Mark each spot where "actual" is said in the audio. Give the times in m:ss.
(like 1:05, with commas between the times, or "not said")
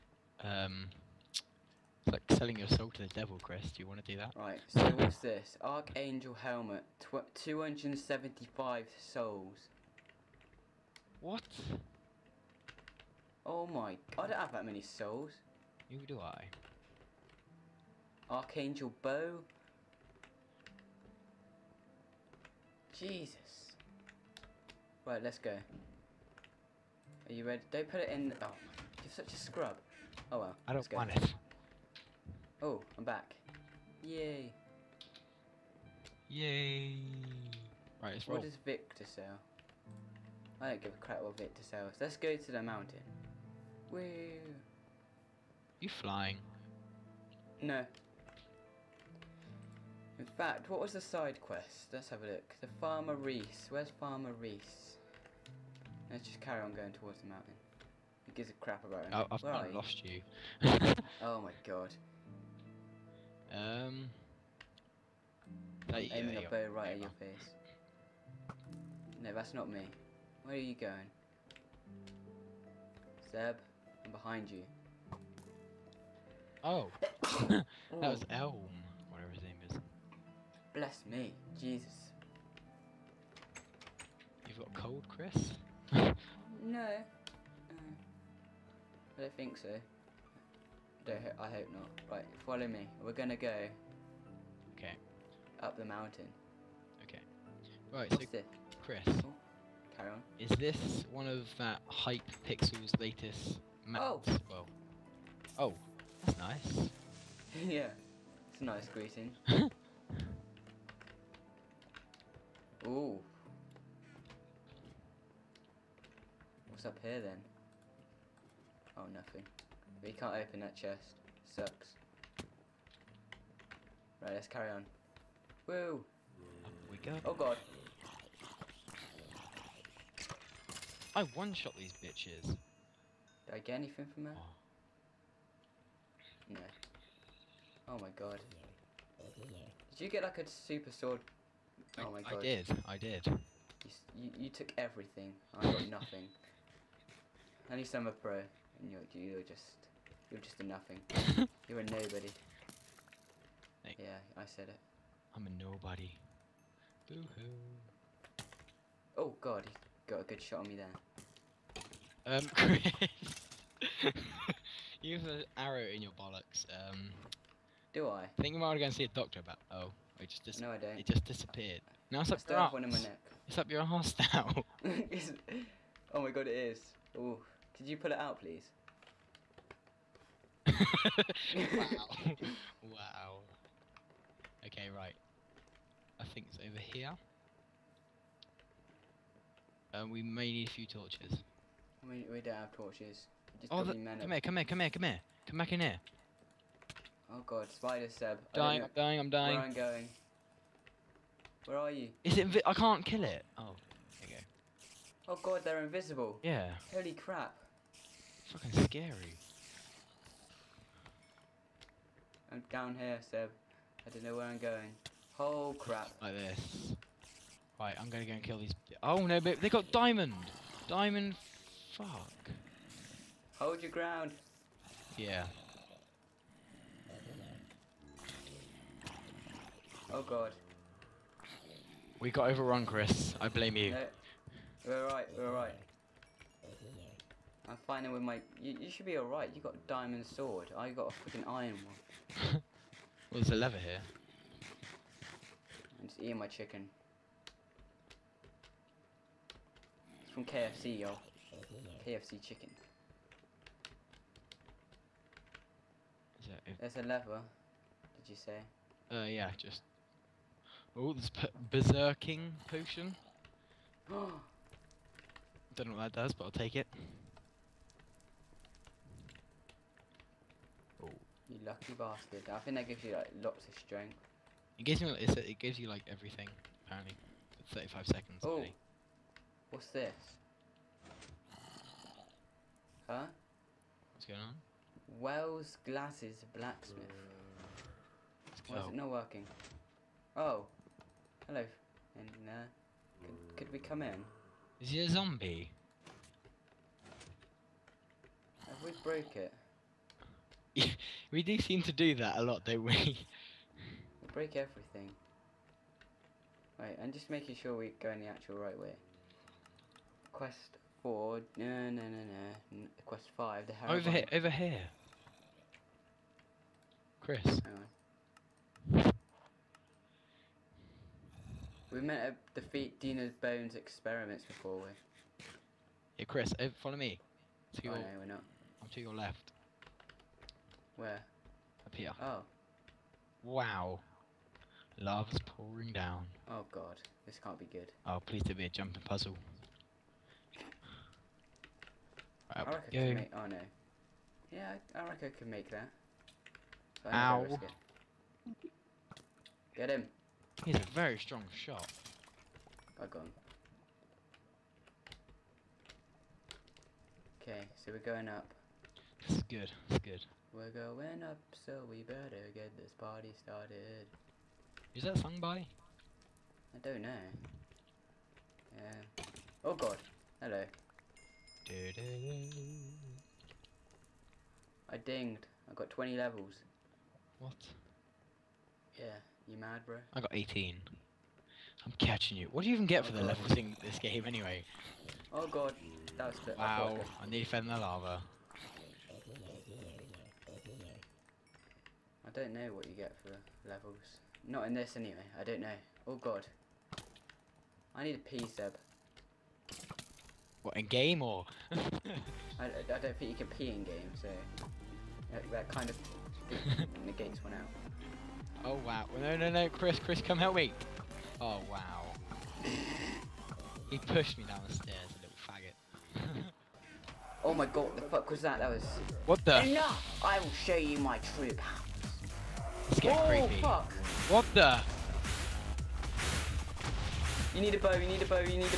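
5:08.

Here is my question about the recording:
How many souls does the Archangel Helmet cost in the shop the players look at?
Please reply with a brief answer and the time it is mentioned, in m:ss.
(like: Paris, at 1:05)
275, at 0:07.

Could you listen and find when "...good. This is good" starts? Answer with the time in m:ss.
5:59.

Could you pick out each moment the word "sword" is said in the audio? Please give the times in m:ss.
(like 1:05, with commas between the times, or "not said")
2:20, 4:00.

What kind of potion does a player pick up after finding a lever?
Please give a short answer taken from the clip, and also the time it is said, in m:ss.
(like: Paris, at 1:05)
Berserking potion, at 4:21.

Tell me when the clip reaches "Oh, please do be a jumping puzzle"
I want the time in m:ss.
5:38.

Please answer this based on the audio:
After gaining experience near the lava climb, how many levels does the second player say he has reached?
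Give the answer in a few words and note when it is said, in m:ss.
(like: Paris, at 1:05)
18, at 6:20.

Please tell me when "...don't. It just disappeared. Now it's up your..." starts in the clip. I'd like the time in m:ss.
2:50.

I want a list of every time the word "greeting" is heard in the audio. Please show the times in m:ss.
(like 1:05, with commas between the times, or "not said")
1:48.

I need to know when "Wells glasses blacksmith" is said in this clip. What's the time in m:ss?
4:45.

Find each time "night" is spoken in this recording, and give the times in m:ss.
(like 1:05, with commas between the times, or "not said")
not said.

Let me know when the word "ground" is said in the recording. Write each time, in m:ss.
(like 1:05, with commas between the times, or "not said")
3:43.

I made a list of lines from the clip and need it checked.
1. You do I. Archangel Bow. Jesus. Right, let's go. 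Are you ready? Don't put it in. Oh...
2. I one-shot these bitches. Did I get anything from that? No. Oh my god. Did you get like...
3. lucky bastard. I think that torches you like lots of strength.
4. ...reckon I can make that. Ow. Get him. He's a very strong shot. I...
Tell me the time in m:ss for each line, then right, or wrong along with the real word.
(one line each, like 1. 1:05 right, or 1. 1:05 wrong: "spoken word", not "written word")
1. 0:15 right
2. 2:11 right
3. 4:31 wrong: "gives", not "torches"
4. 5:45 right.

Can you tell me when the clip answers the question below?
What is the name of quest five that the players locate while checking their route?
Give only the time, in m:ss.
5:13.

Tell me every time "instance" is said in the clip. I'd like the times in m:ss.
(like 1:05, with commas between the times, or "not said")
not said.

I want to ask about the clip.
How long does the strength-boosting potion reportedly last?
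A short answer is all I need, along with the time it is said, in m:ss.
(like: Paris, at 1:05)
35 seconds, at 4:37.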